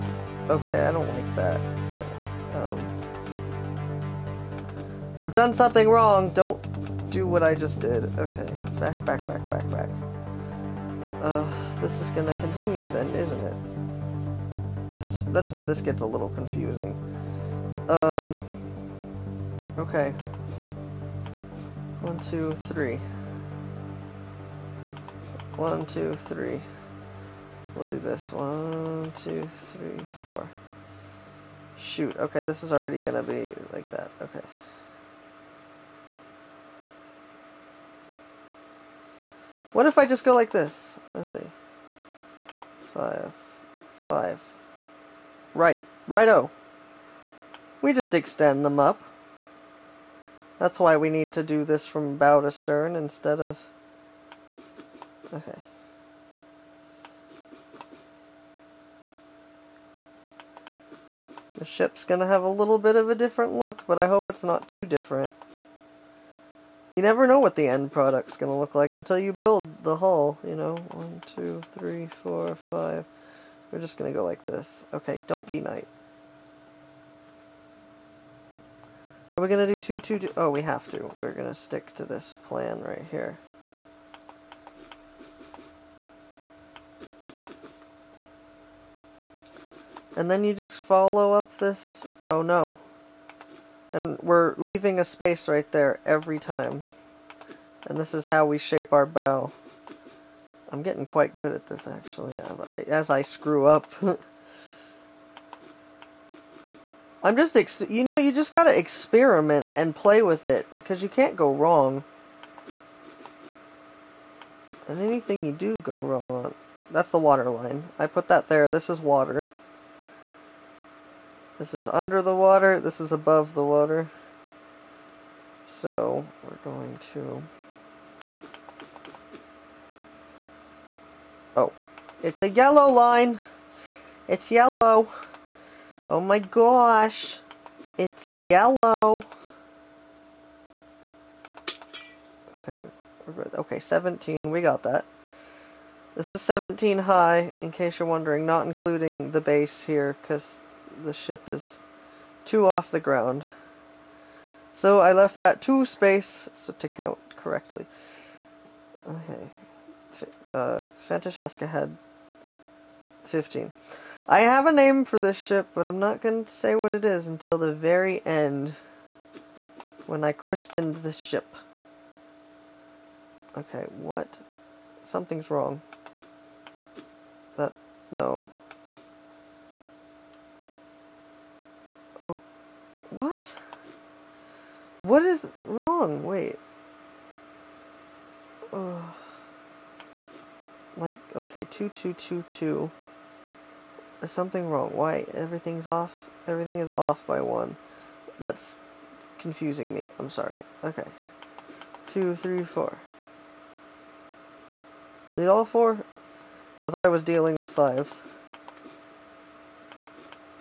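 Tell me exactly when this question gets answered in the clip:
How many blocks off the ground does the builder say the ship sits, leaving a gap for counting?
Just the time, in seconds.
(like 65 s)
152 s.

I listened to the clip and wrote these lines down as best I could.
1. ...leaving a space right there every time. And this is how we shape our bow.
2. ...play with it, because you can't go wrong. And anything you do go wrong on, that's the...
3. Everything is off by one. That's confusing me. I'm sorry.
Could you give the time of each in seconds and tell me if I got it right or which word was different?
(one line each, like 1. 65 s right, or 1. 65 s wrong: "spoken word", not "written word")
1. 94 s right
2. 109 s right
3. 196 s right.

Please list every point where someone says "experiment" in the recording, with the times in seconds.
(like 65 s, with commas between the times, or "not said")
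108 s.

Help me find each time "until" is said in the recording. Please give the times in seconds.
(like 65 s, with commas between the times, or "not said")
68 s, 167 s.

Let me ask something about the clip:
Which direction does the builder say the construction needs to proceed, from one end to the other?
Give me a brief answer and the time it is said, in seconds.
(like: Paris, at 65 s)
Bow to stern, at 52 s.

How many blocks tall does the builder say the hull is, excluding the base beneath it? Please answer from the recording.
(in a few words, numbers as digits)
17.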